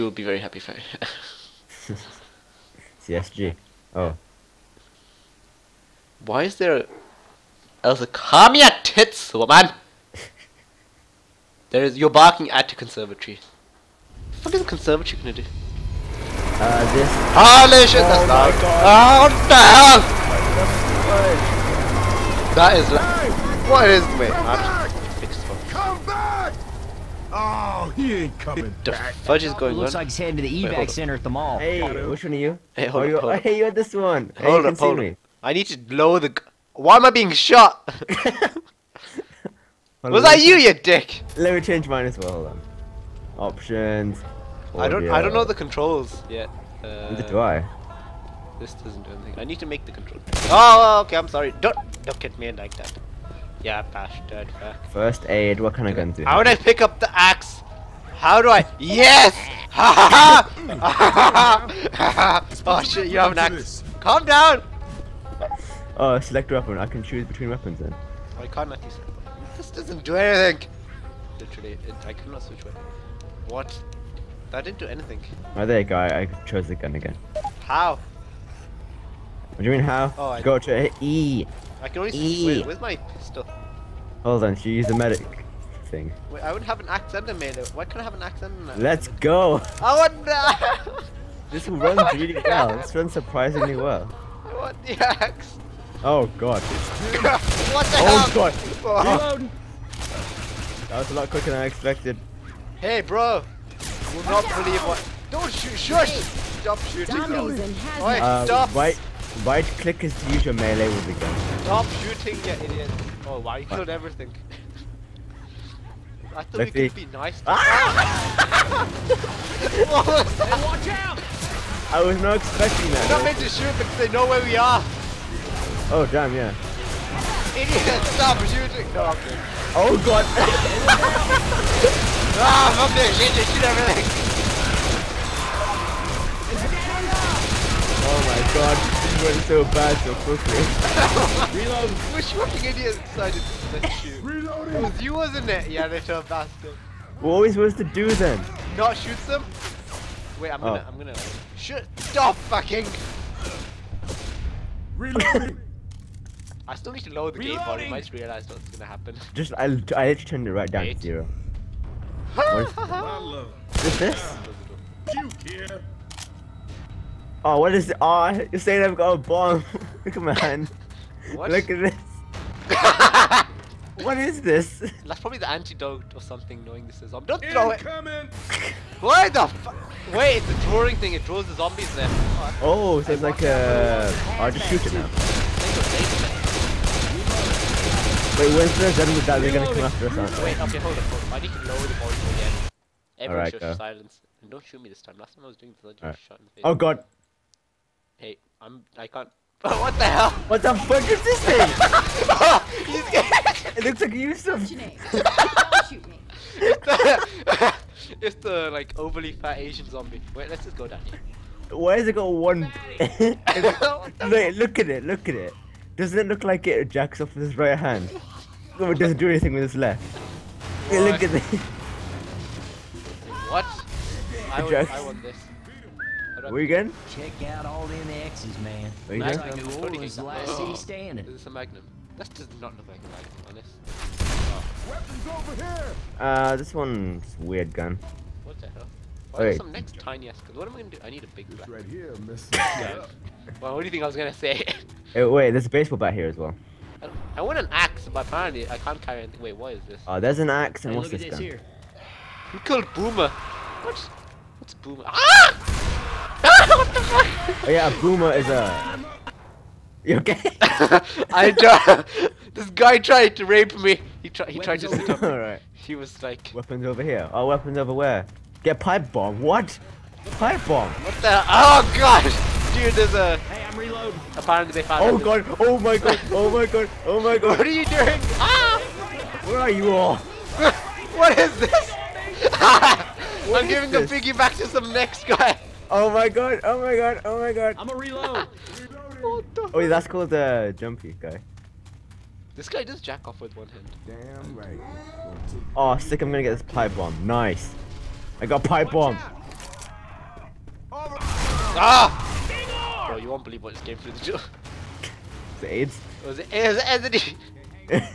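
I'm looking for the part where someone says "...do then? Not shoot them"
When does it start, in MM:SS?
02:27.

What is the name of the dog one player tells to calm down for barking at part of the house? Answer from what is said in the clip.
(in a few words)
Elsa.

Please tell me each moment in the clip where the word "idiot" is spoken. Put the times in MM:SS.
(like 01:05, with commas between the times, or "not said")
01:52, 02:07, 02:22.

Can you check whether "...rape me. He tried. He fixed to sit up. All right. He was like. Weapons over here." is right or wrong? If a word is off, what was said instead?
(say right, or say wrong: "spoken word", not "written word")
wrong: "tried", not "fixed".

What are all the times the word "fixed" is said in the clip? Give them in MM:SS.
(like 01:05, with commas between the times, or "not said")
00:25.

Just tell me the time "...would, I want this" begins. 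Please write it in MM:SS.
03:44.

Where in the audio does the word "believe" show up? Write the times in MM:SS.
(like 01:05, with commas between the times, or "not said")
01:44, 05:03.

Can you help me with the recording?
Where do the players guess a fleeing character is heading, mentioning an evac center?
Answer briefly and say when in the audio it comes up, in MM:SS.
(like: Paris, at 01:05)
the mall, at 00:31.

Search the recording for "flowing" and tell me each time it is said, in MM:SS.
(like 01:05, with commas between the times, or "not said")
not said.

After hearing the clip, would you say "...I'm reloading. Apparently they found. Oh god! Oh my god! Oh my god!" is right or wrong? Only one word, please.
right.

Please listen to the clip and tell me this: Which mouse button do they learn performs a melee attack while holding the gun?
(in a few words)
right click.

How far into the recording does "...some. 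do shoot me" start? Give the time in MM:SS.
03:24.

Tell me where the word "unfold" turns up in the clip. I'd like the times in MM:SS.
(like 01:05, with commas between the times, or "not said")
not said.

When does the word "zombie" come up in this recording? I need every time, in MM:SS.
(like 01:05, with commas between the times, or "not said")
02:57, 03:01, 03:29.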